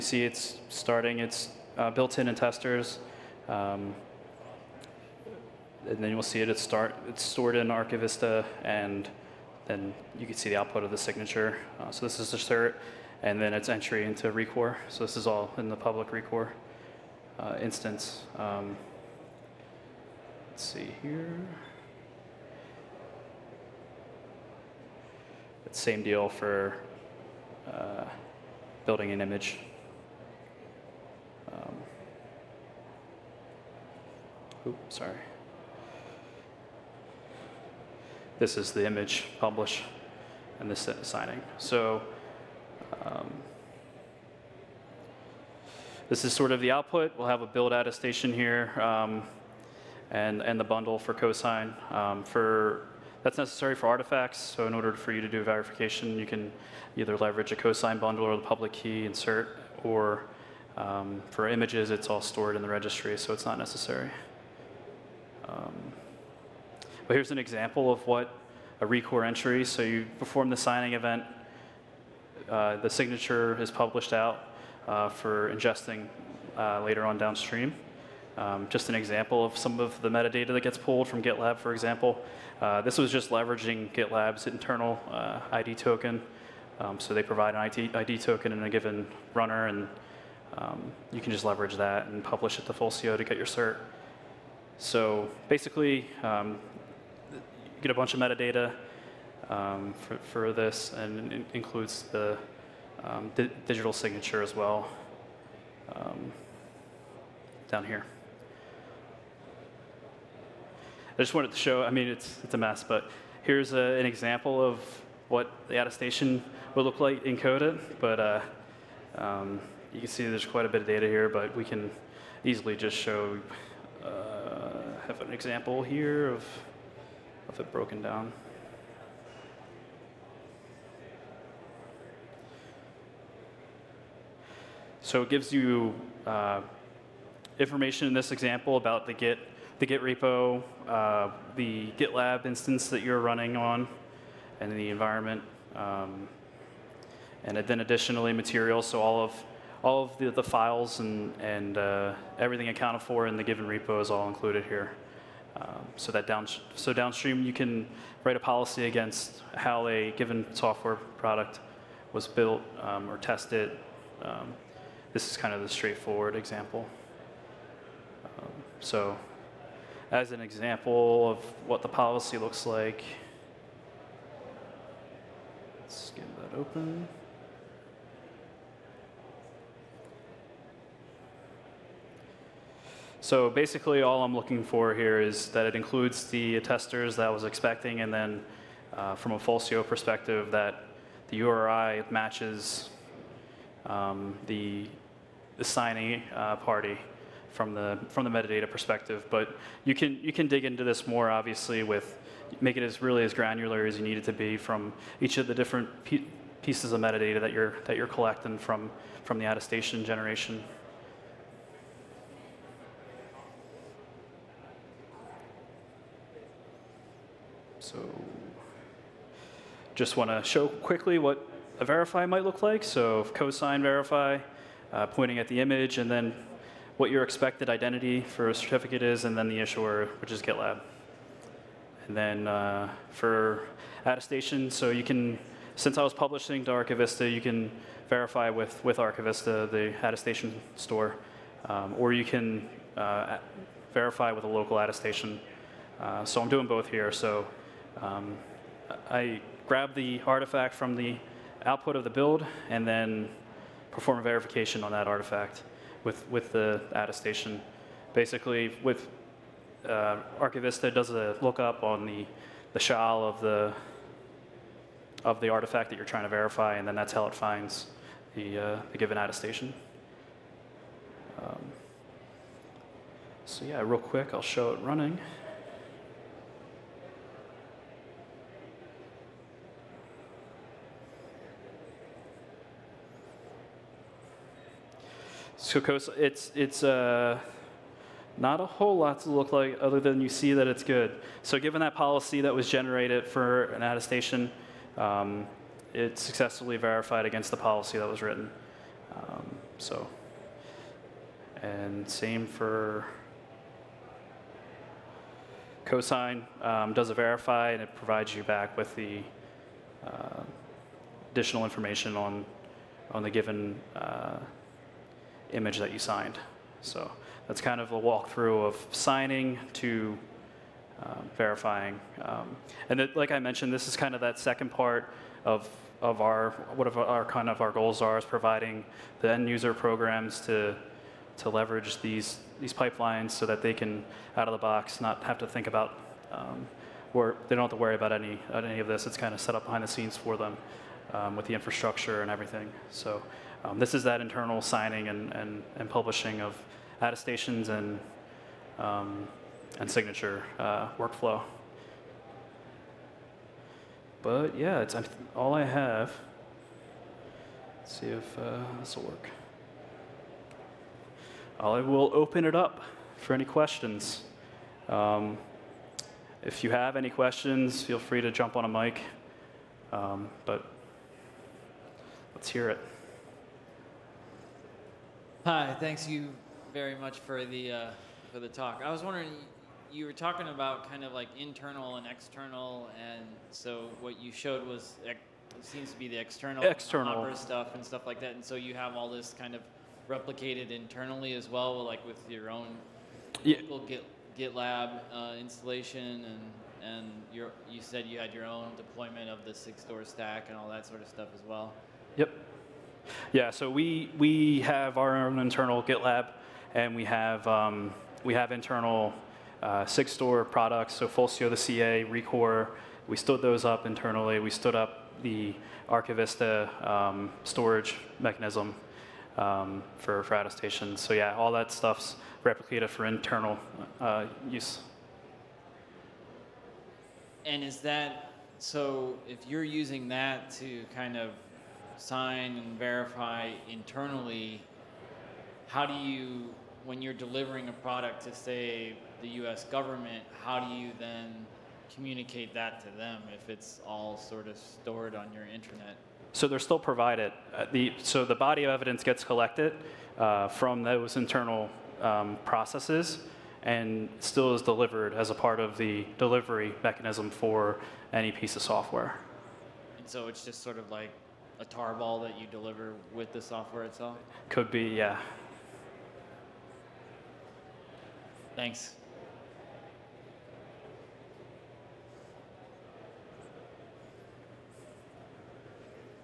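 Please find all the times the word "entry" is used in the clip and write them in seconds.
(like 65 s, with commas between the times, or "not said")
13 s, 69 s.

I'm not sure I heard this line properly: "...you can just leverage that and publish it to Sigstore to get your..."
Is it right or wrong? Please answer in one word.
wrong.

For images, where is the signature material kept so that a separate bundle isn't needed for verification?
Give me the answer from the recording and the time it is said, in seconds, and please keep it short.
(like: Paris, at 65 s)
In the registry, at 62 s.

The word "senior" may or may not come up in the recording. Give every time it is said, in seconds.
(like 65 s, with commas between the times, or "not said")
not said.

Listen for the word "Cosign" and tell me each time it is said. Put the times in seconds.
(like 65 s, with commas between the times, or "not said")
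51 s, 57 s, 223 s, 305 s.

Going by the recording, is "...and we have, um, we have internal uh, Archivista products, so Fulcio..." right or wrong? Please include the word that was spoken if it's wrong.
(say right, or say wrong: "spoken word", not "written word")
wrong: "Sigstore", not "Archivista".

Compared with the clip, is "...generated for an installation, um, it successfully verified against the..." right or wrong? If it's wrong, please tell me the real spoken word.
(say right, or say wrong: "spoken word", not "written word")
wrong: "attestation", not "installation".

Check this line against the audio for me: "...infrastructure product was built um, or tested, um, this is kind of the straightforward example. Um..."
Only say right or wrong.
wrong.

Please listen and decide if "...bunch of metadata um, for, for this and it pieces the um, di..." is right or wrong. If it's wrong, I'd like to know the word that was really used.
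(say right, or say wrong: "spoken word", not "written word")
wrong: "includes", not "pieces".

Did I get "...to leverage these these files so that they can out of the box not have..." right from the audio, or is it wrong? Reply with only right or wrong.
wrong.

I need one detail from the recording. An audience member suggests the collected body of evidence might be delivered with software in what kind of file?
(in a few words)
A tarball.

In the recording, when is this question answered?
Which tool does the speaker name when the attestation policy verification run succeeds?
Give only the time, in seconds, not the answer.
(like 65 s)
285 s.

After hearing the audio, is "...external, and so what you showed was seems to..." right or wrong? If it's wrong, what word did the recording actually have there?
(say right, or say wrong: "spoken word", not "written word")
right.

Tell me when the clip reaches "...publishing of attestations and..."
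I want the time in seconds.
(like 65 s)
345 s.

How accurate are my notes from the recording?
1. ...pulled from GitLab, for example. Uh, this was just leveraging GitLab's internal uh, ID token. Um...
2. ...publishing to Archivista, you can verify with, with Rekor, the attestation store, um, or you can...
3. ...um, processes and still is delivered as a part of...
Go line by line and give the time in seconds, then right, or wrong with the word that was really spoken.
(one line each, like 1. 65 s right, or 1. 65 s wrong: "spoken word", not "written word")
1. 80 s right
2. 236 s wrong: "Archivista", not "Rekor"
3. 452 s right.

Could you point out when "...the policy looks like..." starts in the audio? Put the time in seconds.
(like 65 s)
171 s.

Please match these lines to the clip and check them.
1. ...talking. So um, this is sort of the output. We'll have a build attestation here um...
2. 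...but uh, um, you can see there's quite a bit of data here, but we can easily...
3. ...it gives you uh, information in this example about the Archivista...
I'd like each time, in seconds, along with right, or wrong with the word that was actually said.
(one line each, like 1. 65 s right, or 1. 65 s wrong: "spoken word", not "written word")
1. 41 s wrong: "signing", not "talking"
2. 118 s right
3. 135 s wrong: "Git", not "Archivista".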